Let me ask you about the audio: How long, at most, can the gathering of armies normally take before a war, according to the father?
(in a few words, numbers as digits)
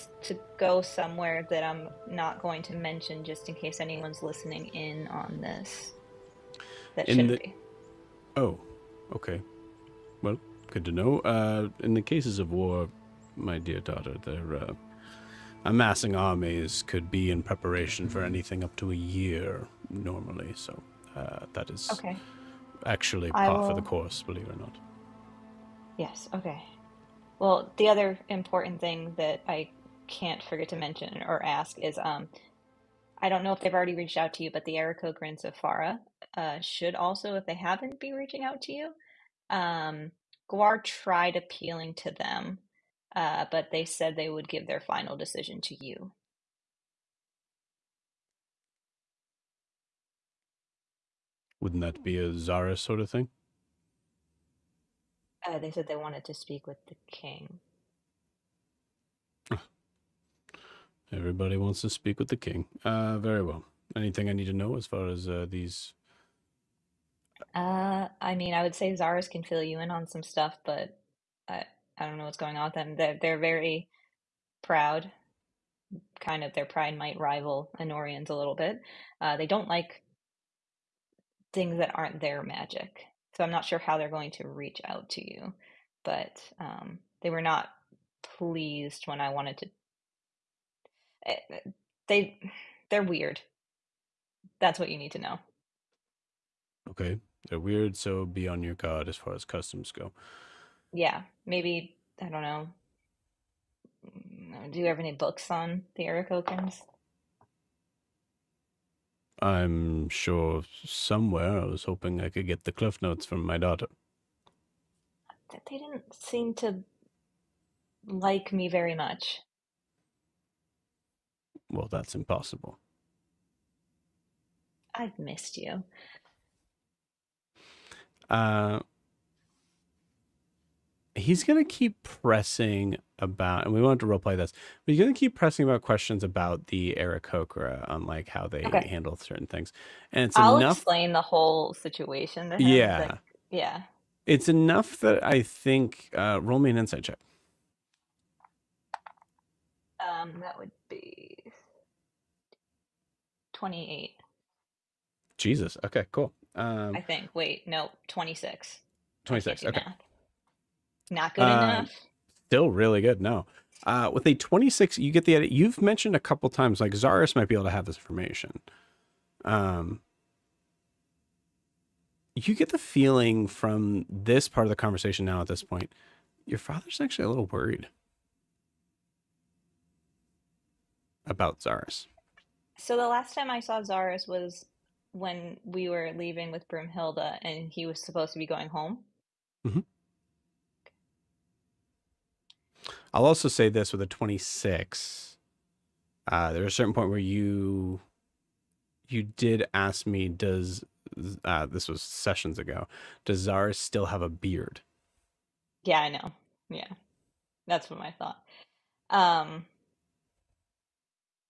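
up to a year.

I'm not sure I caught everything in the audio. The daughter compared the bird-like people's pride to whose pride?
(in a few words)
Anorians.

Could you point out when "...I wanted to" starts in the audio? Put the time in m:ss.
1:29.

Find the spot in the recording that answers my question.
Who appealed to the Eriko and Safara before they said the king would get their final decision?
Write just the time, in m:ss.
0:40.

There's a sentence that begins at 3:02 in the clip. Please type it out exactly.
So the last time I saw Zaris was when we were leaving with Brumhilda and he was supposed to be going home.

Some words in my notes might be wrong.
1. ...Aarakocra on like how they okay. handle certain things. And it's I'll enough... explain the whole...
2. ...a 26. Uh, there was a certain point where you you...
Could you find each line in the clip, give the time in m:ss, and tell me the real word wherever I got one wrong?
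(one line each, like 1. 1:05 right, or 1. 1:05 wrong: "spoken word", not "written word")
1. 2:16 right
2. 3:14 right.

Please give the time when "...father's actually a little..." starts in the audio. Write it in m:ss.
2:56.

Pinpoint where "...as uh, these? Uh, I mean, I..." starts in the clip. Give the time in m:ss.
1:05.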